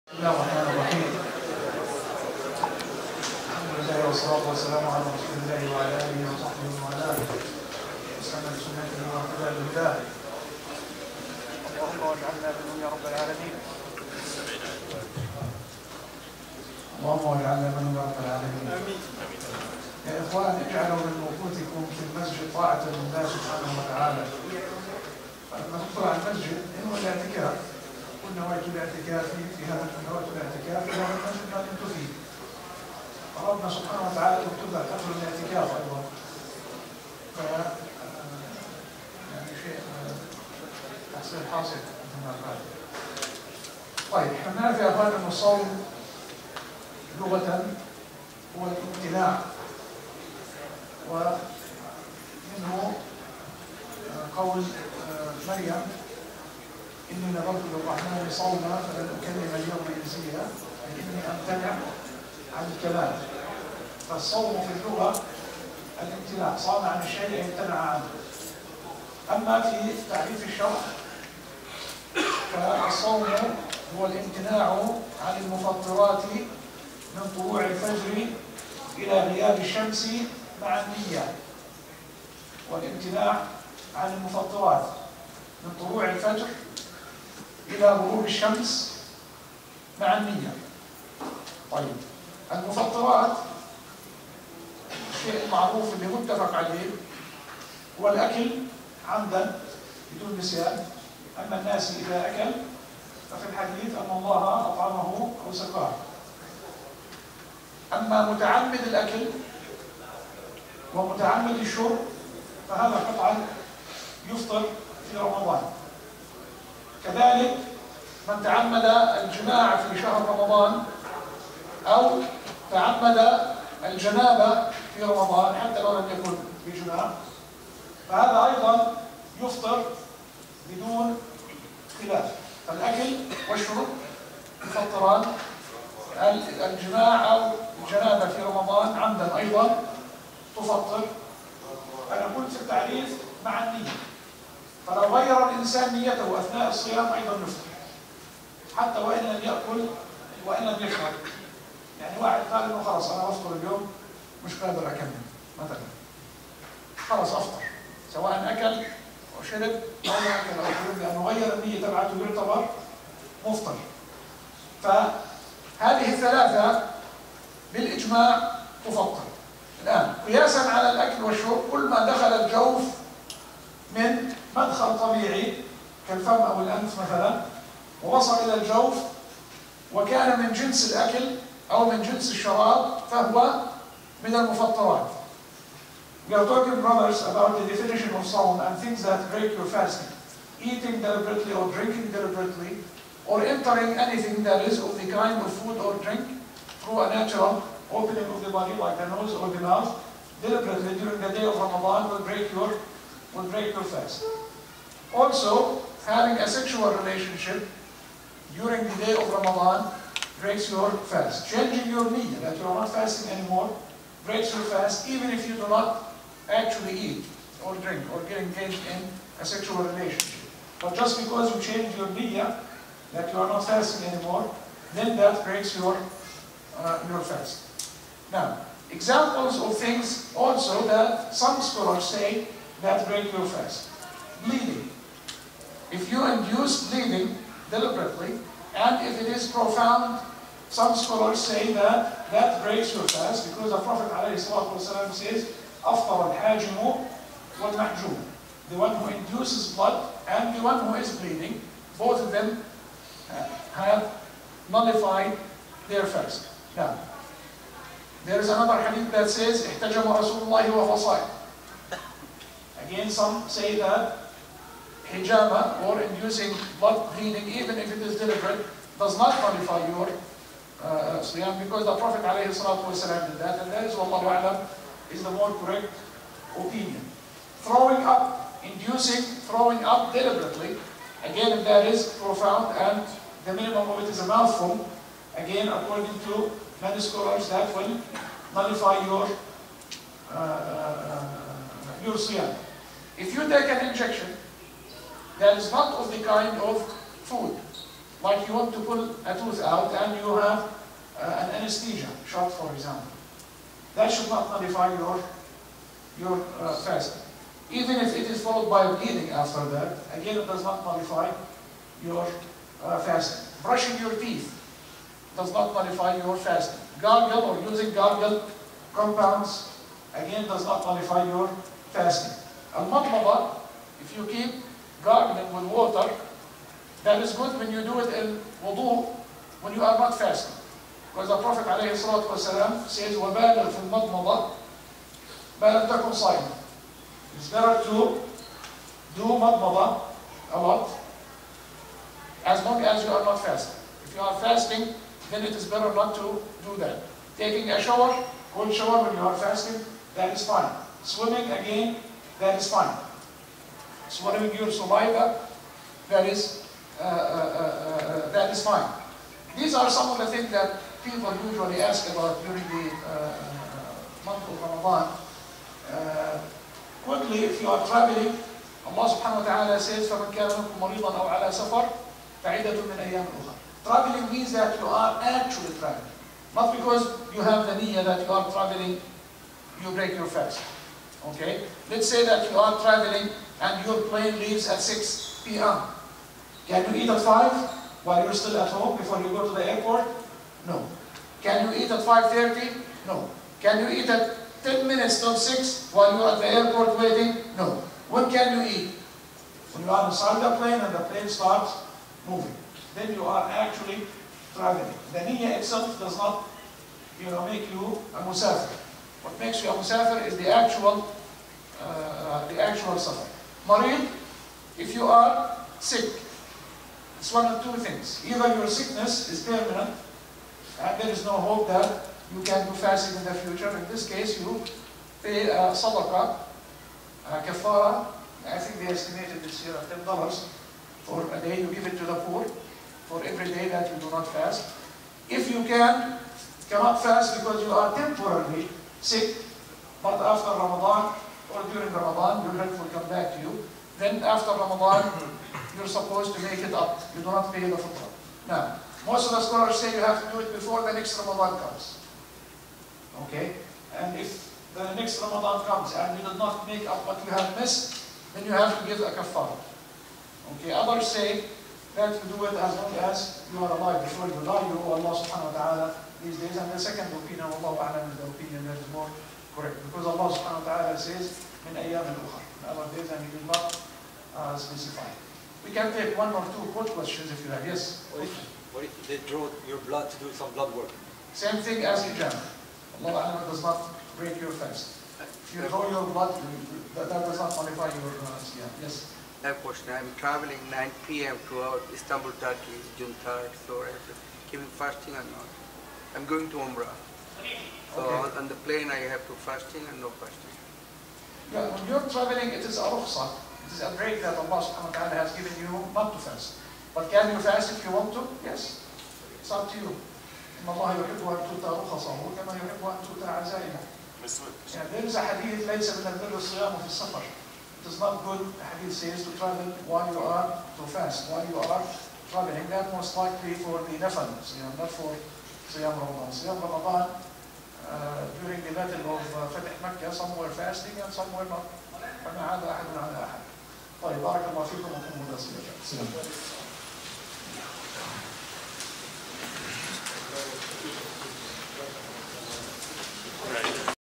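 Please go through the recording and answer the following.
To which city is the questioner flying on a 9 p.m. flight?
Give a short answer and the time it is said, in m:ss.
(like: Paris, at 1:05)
Istanbul, at 8:11.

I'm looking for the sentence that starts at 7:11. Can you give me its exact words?
You give it to the poor for every day that you do not fast.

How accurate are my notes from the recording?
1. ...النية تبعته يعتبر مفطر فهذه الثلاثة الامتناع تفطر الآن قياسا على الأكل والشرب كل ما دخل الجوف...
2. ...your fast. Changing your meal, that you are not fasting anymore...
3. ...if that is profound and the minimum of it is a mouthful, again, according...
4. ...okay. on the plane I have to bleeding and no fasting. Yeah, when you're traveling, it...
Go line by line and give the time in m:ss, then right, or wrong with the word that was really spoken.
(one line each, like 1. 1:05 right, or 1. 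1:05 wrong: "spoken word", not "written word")
1. 2:41 wrong: "بالإجماع", not "الامتناع"
2. 3:30 right
3. 4:41 right
4. 8:18 wrong: "fasting", not "bleeding".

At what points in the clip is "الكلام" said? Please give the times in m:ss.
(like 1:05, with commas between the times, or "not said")
1:02.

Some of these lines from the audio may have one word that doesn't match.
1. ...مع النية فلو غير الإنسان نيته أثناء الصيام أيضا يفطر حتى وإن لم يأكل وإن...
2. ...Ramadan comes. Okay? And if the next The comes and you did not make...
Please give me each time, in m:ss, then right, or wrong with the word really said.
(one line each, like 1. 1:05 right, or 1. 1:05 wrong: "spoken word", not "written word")
1. 2:23 right
2. 7:31 wrong: "Ramadan", not "The".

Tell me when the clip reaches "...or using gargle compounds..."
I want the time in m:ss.
5:17.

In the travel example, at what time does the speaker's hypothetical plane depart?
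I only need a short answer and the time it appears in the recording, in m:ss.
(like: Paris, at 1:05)
6 p.m., at 6:24.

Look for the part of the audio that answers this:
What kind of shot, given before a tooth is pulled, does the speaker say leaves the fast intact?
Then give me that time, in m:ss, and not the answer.
5:01.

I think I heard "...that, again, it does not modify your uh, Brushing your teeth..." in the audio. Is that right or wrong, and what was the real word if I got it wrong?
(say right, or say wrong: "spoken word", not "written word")
right.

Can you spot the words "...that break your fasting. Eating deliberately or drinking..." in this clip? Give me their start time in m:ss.
3:09.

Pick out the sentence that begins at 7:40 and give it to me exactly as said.
Okay, others say that you do it as long as you are alive.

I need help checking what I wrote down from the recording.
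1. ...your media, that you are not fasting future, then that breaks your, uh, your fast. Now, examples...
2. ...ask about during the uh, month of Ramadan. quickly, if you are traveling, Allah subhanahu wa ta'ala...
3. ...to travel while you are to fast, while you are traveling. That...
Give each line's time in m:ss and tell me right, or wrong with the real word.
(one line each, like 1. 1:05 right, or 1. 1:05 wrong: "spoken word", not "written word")
1. 3:41 wrong: "anymore", not "future"
2. 6:01 right
3. 8:39 right.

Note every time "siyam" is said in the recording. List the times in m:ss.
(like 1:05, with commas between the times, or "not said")
4:31, 4:52, 8:08.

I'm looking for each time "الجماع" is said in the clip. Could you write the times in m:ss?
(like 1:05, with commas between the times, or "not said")
1:59, 2:16.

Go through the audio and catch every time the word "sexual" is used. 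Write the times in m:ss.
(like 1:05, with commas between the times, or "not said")
3:26, 3:39.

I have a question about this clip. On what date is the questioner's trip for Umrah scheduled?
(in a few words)
June 3rd.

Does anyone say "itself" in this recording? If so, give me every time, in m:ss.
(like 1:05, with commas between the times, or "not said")
6:45.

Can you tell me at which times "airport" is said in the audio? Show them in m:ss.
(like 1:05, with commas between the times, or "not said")
6:29, 6:36.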